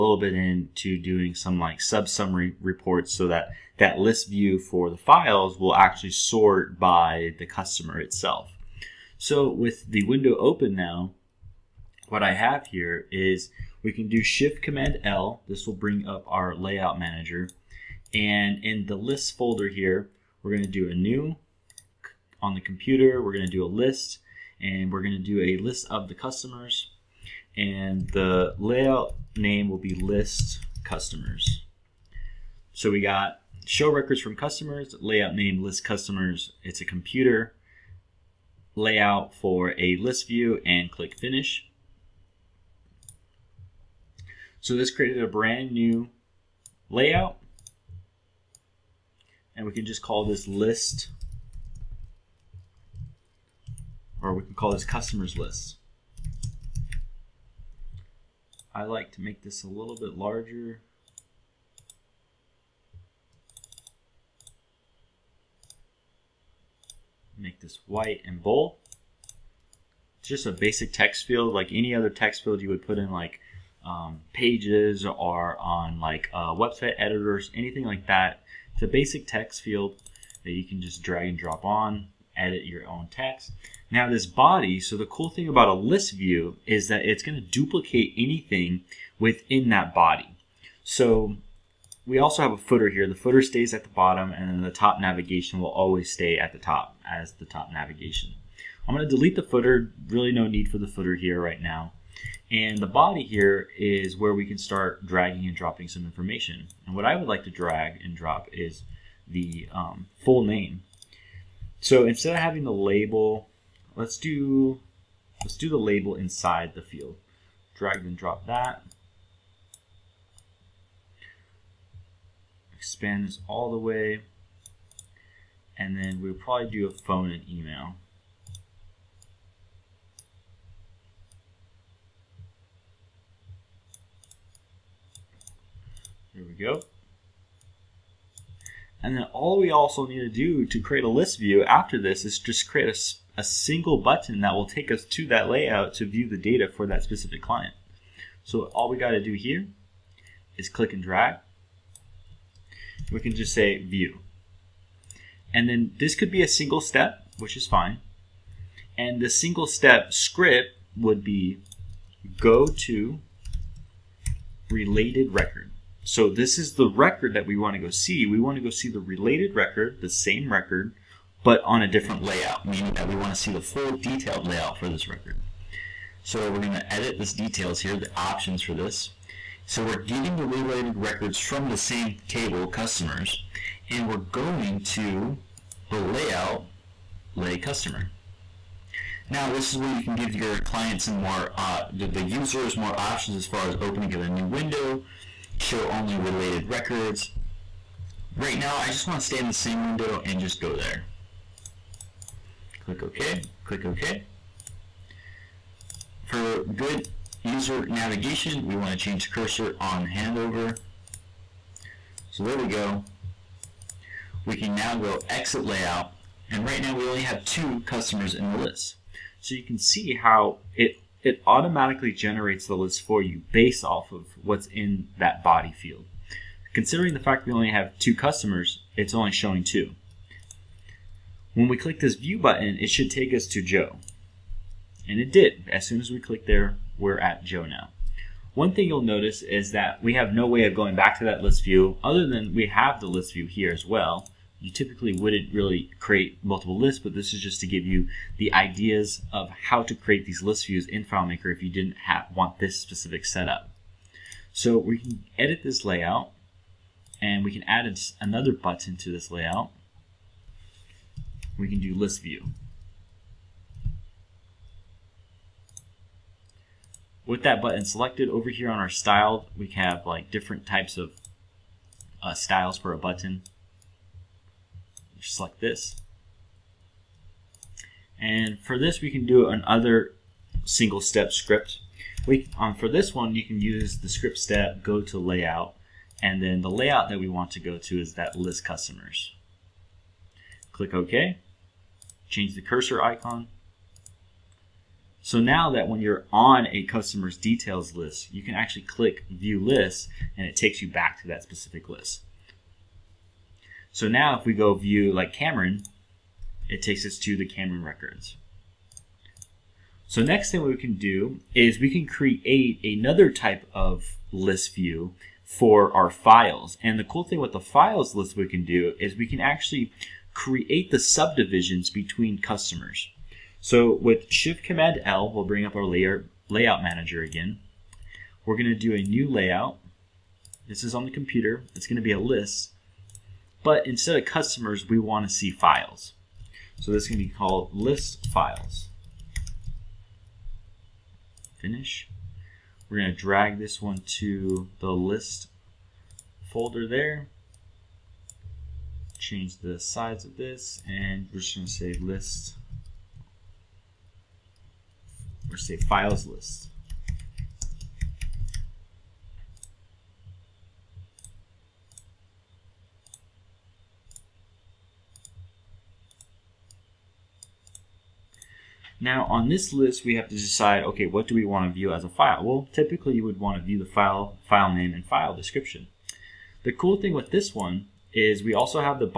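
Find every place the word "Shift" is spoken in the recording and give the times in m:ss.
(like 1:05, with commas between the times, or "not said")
0:14, 5:24.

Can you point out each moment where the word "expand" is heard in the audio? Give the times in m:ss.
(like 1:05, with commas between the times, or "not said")
2:02.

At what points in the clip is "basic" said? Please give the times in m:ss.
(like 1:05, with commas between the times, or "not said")
1:10, 1:18.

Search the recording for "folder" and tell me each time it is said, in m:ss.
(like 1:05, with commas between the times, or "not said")
0:19, 5:46.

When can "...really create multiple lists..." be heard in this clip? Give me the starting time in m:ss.
4:05.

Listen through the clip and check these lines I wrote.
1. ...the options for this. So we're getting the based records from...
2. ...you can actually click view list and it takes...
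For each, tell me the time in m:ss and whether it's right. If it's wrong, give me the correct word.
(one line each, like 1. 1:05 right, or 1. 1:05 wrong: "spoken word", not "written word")
1. 2:57 wrong: "related", not "based"
2. 4:58 right.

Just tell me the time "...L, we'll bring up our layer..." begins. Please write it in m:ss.
5:25.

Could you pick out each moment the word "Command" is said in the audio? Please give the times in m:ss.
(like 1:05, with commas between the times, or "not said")
0:14, 5:24.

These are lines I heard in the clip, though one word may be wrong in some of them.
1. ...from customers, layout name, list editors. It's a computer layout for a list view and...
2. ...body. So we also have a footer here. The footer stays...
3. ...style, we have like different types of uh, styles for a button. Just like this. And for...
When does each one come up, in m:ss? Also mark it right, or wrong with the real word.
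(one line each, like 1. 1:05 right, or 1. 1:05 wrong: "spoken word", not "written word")
1. 0:34 wrong: "customers", not "editors"
2. 1:29 right
3. 4:28 right.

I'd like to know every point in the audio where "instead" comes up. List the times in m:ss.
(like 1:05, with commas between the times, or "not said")
1:52, 5:33.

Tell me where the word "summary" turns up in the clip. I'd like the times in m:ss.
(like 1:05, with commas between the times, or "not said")
0:02.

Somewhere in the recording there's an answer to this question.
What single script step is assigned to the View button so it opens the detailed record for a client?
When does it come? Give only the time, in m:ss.
2:42.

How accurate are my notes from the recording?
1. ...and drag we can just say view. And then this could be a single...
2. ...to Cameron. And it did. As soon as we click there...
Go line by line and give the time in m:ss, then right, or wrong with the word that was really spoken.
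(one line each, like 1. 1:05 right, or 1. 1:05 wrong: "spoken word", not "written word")
1. 2:30 right
2. 3:53 wrong: "Joe", not "Cameron".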